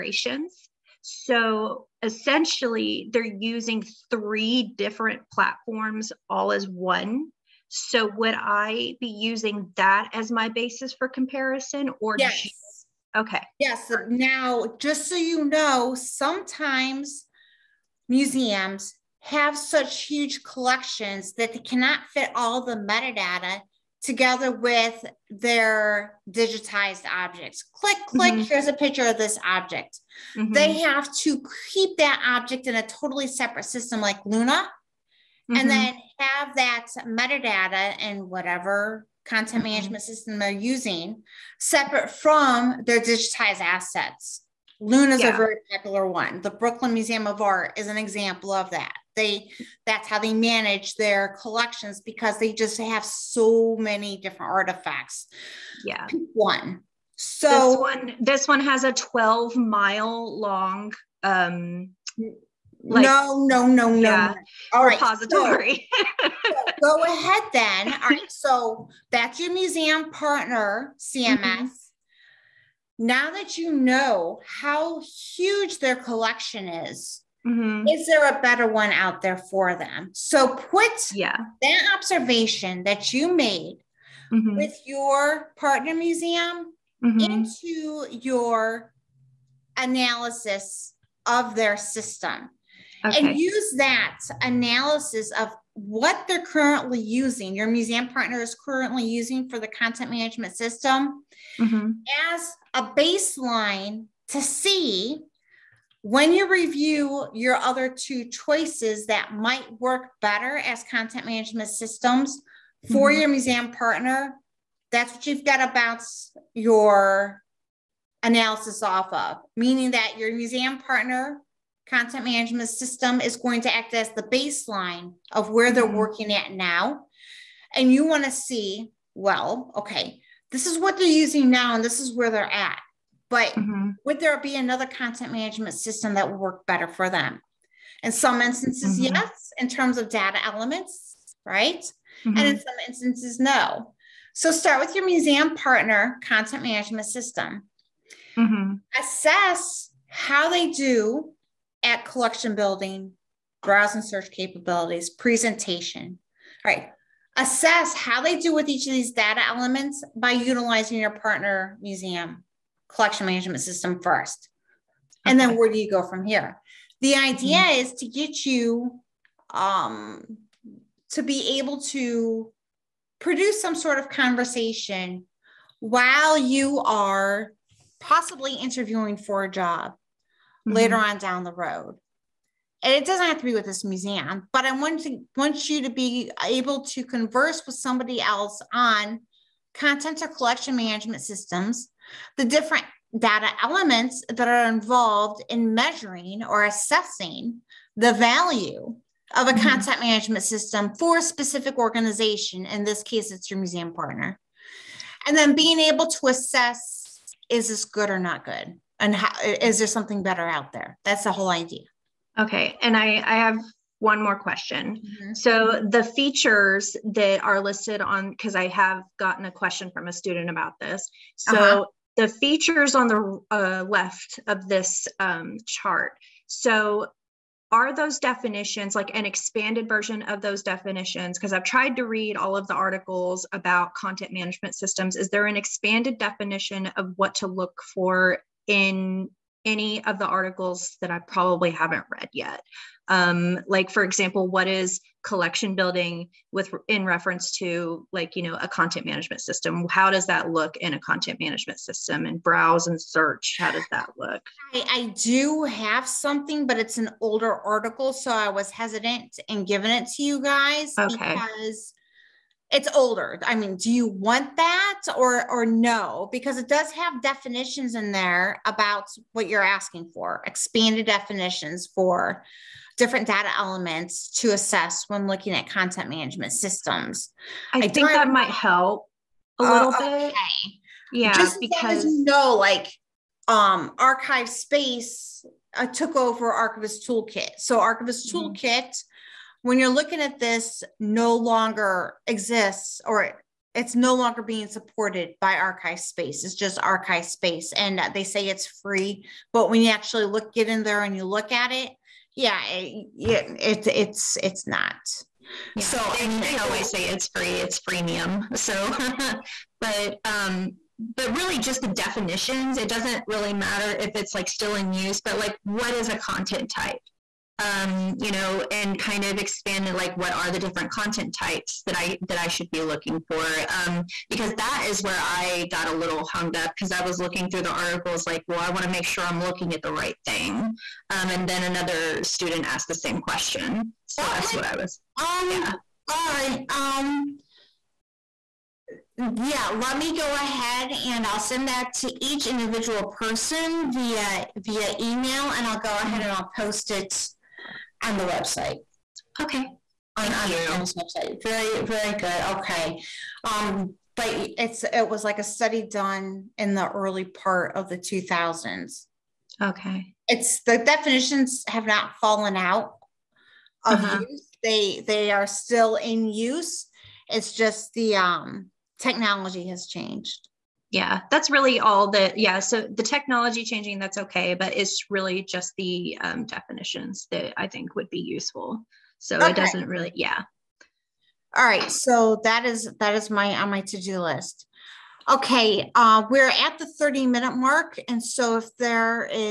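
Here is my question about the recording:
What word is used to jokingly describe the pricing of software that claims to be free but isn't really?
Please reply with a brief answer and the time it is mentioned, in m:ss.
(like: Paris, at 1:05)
freemium, at 5:07.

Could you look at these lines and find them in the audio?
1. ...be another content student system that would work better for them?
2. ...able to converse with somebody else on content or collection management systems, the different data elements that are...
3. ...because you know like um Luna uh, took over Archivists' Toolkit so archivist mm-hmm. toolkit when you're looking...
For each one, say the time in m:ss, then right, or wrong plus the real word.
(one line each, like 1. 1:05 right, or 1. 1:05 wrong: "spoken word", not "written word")
1. 2:14 wrong: "management", not "student"
2. 3:06 right
3. 4:41 wrong: "ArchivesSpace", not "Luna".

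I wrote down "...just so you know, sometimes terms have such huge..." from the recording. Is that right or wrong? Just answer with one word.
wrong.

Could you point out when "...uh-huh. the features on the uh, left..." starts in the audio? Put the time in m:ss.
3:41.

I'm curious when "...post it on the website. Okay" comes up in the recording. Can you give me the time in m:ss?
5:46.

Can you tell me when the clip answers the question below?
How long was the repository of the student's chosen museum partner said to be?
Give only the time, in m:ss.
0:58.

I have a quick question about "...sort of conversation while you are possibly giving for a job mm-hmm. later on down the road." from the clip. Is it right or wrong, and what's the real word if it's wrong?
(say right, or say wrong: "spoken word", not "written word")
wrong: "interviewing", not "giving".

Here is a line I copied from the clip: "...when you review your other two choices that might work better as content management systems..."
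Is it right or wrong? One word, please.
right.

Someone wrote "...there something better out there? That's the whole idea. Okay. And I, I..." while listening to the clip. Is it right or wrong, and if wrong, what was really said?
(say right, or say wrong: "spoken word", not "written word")
right.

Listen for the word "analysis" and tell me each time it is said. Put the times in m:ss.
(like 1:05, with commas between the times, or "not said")
1:29, 1:34, 1:58.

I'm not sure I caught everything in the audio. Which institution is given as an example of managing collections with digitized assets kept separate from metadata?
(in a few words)
Brooklyn Museum of Art.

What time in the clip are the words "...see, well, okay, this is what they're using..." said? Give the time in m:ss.
2:08.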